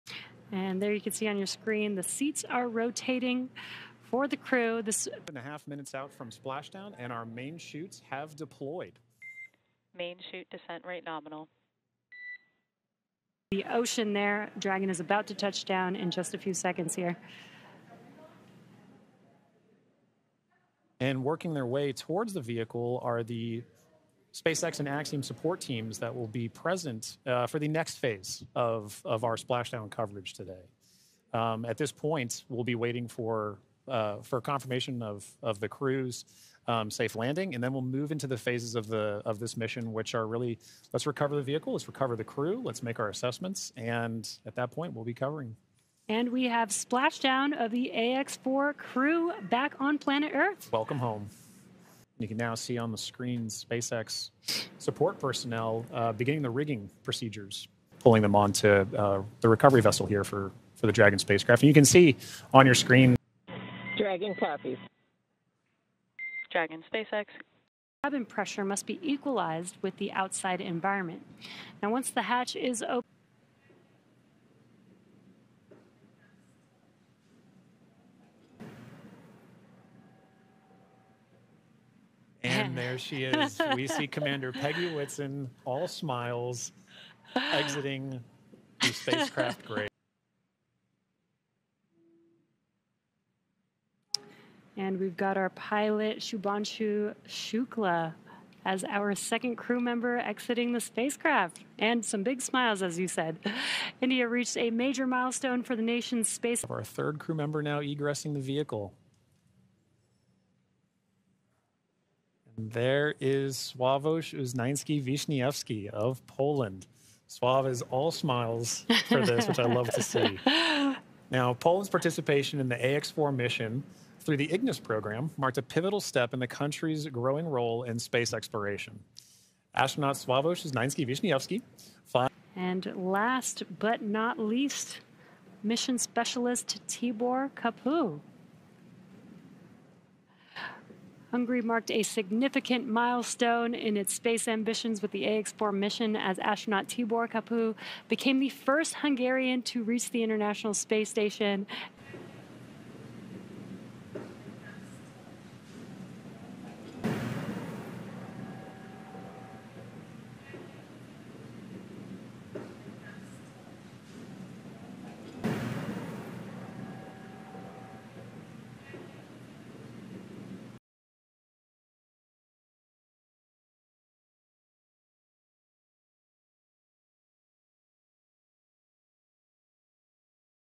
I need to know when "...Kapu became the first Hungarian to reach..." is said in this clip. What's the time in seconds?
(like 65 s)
147 s.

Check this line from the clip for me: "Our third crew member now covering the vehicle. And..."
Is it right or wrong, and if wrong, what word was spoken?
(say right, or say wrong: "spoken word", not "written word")
wrong: "egressing", not "covering".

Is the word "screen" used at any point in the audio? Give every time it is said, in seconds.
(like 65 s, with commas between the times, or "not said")
1 s, 52 s, 62 s.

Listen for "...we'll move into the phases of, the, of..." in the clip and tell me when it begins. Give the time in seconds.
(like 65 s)
37 s.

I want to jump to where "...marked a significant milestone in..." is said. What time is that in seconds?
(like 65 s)
141 s.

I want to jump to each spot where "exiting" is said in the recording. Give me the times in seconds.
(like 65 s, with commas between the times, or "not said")
87 s, 100 s.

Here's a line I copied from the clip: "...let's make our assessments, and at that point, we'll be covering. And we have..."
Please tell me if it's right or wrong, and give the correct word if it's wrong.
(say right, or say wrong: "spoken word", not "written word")
right.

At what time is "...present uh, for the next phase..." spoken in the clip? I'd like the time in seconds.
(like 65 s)
26 s.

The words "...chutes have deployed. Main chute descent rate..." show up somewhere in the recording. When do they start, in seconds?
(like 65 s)
7 s.